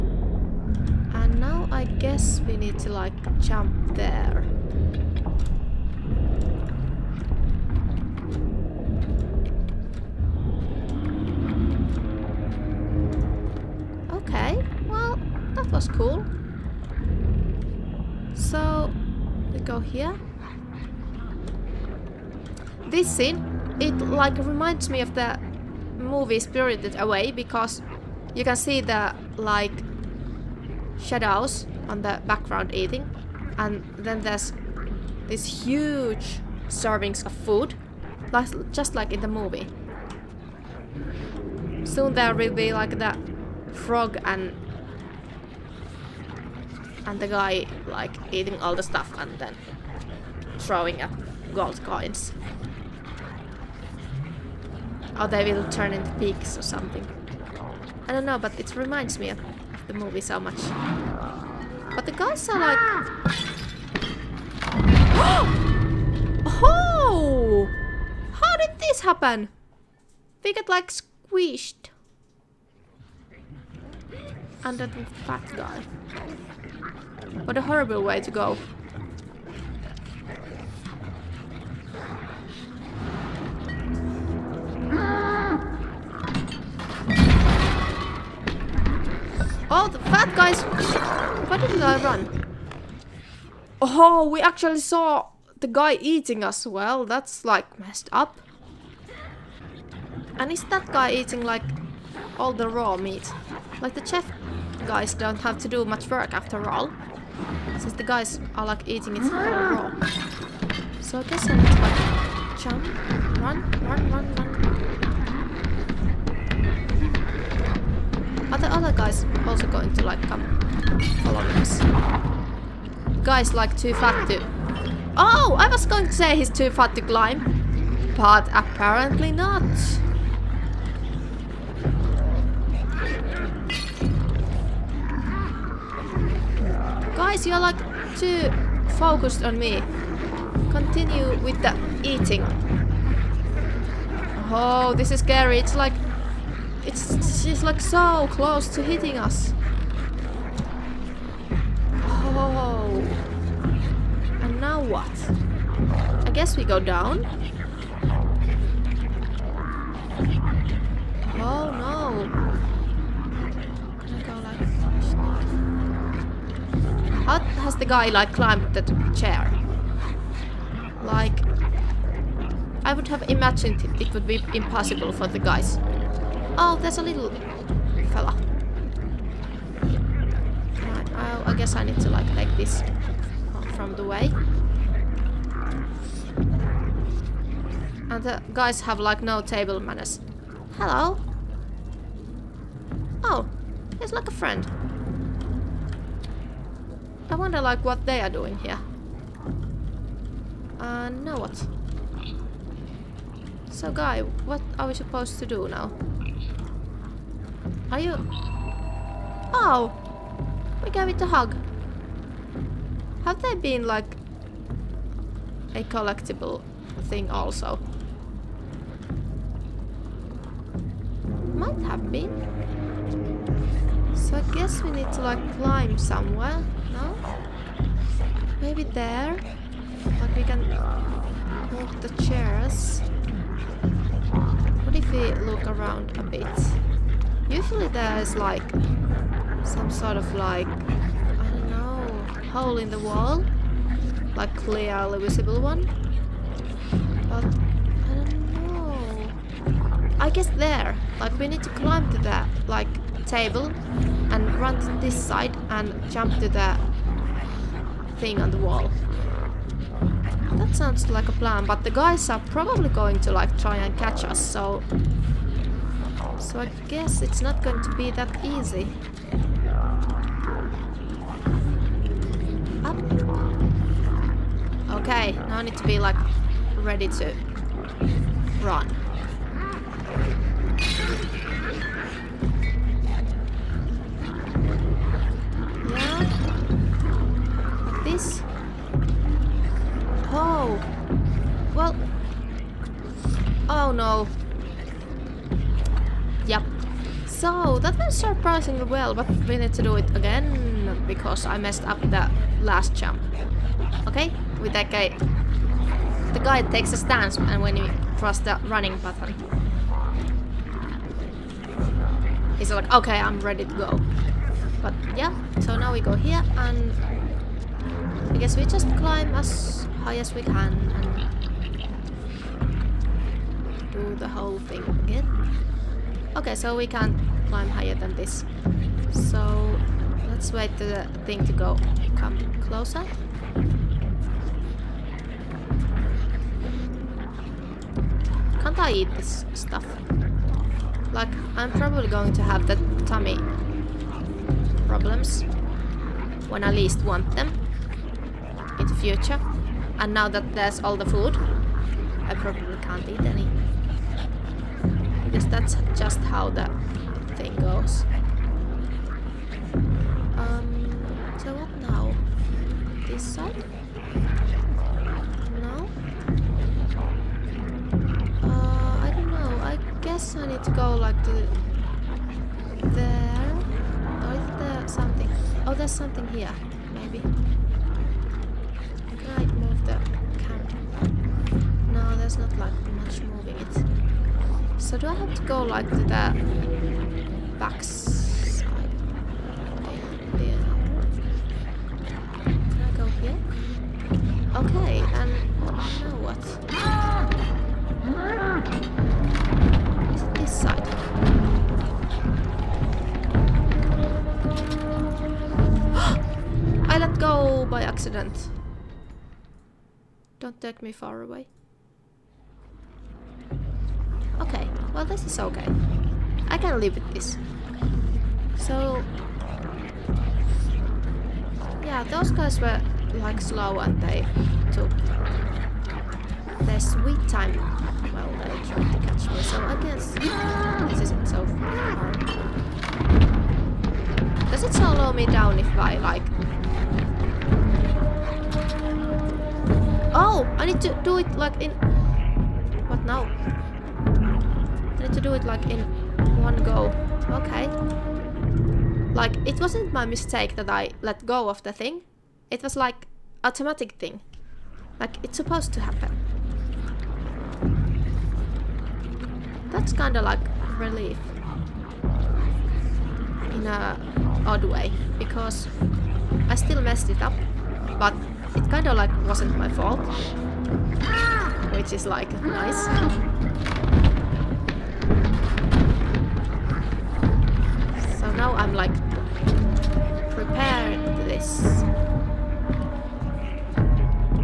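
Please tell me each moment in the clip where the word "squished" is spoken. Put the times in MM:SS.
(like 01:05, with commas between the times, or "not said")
01:10.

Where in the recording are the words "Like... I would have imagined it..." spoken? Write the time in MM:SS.
02:51.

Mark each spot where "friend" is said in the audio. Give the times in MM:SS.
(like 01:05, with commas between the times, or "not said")
03:14.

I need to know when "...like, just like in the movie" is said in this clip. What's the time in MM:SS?
00:38.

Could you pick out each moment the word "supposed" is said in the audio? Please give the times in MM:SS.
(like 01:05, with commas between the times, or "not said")
03:24, 07:35.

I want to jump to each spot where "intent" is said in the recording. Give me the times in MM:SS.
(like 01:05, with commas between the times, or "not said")
not said.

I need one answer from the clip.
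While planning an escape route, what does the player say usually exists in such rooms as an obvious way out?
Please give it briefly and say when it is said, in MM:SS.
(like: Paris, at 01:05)
hole in the wall, at 04:02.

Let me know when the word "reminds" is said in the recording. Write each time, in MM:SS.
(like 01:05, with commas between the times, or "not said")
00:24, 00:58.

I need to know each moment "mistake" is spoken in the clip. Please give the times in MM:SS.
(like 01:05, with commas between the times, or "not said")
07:30.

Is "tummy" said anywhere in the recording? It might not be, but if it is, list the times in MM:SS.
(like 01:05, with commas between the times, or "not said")
05:43.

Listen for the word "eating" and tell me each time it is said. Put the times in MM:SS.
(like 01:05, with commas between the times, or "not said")
00:32, 00:48, 01:35, 01:41, 01:48, 02:22.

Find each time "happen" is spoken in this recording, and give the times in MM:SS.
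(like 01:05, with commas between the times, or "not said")
01:09, 07:35.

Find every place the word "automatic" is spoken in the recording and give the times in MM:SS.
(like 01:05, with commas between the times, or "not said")
07:33.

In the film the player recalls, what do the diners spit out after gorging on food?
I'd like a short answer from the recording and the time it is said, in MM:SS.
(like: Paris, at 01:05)
gold coins, at 00:51.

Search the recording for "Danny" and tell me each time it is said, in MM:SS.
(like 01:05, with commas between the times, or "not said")
not said.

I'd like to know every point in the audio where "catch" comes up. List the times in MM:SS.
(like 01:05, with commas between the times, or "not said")
04:23, 07:09.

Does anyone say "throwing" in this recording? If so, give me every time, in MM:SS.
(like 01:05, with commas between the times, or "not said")
00:50.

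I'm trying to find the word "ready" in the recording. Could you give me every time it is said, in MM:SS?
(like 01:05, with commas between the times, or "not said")
04:36, 05:13.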